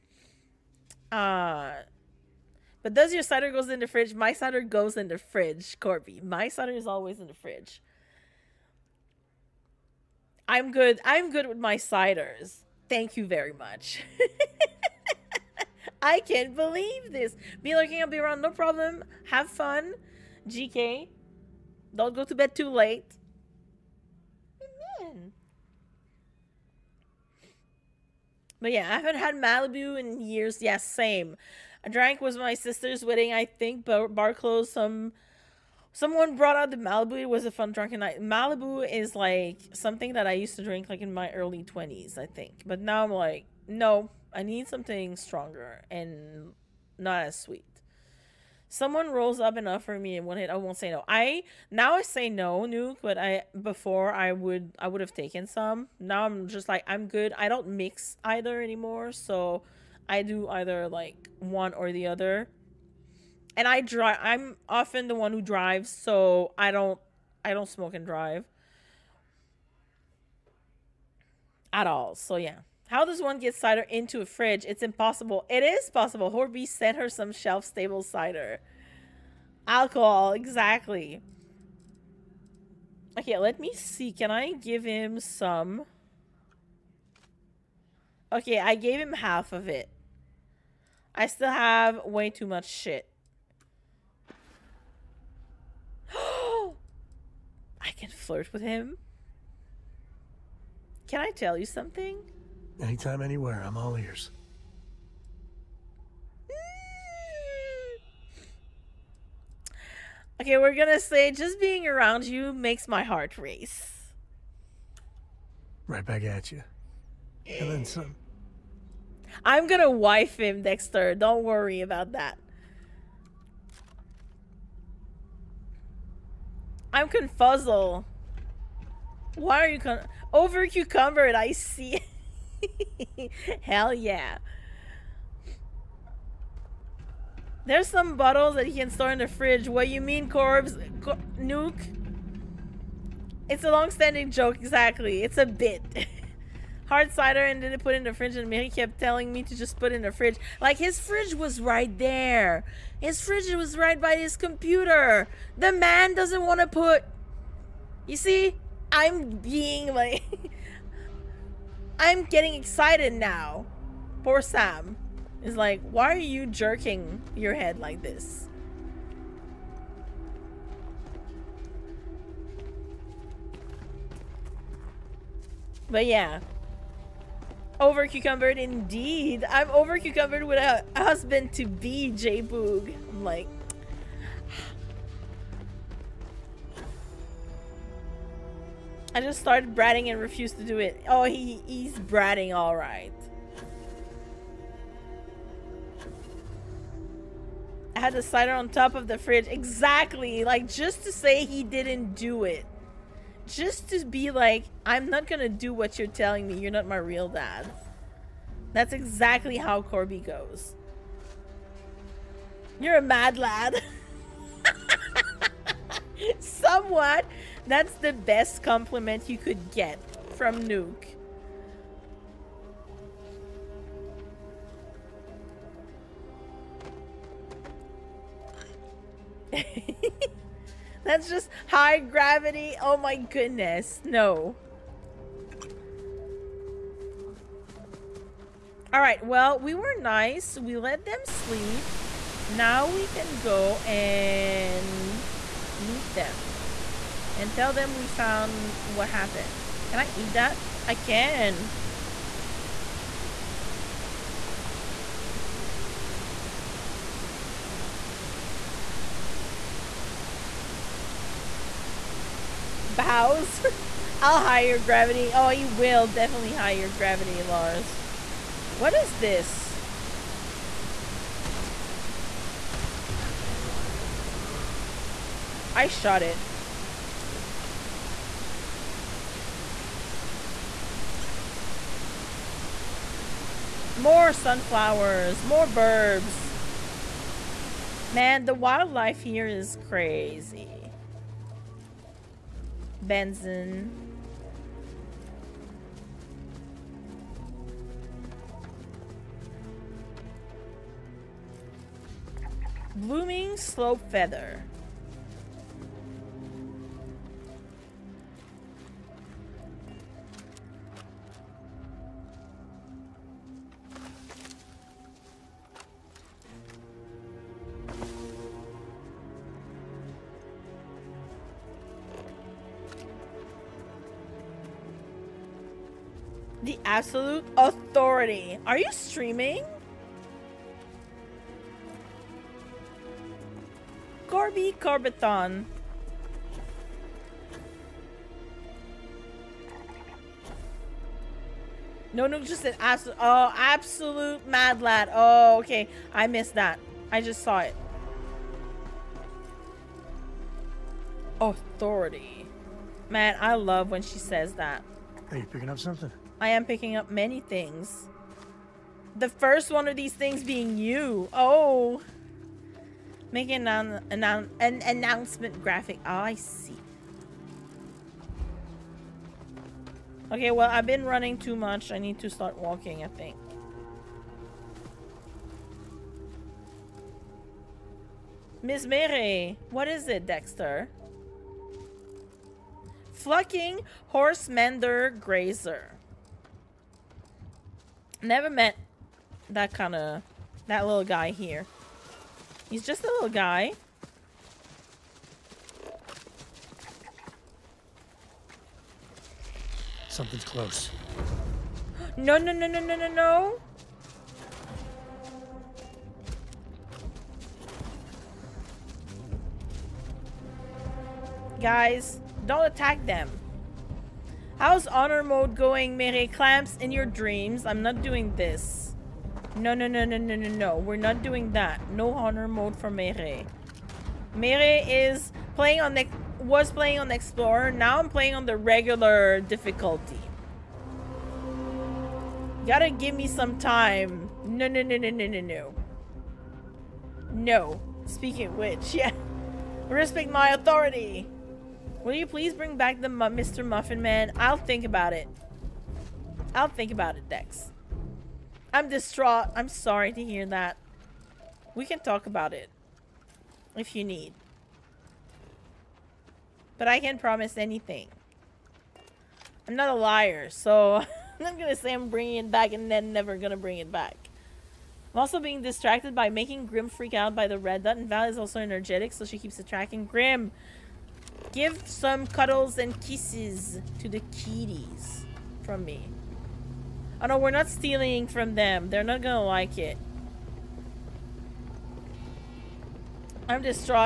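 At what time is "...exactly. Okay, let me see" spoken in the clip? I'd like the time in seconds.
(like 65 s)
80 s.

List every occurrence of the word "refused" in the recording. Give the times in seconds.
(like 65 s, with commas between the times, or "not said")
190 s.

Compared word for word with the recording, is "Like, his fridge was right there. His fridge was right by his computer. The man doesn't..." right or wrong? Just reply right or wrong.
right.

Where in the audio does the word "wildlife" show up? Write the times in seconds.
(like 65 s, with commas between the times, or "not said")
288 s.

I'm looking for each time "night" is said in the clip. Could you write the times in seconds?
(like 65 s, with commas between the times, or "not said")
37 s.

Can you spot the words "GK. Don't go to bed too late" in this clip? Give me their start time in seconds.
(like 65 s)
20 s.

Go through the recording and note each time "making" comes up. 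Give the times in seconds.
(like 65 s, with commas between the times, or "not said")
363 s, 466 s.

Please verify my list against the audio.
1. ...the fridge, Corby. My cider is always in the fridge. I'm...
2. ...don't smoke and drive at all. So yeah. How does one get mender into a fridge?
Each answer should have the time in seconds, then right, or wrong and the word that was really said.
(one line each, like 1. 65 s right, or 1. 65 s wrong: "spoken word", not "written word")
1. 5 s right
2. 67 s wrong: "cider", not "mender".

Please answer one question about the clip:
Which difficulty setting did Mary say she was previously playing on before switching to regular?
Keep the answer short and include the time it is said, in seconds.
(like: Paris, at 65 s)
Explorer, at 426 s.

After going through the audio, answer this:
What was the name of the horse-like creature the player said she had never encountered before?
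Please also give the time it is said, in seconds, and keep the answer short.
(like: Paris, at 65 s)
horse mender grazer, at 383 s.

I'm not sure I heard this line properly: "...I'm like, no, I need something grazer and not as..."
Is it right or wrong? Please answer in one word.
wrong.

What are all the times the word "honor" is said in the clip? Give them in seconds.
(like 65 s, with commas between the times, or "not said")
414 s, 422 s.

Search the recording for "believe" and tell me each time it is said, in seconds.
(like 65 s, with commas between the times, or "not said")
16 s.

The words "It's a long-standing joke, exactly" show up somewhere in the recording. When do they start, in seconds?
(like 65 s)
143 s.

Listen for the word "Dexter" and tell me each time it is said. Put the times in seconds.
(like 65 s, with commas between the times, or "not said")
120 s, 380 s.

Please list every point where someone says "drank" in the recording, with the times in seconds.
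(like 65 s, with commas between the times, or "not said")
31 s.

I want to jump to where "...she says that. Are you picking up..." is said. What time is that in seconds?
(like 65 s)
354 s.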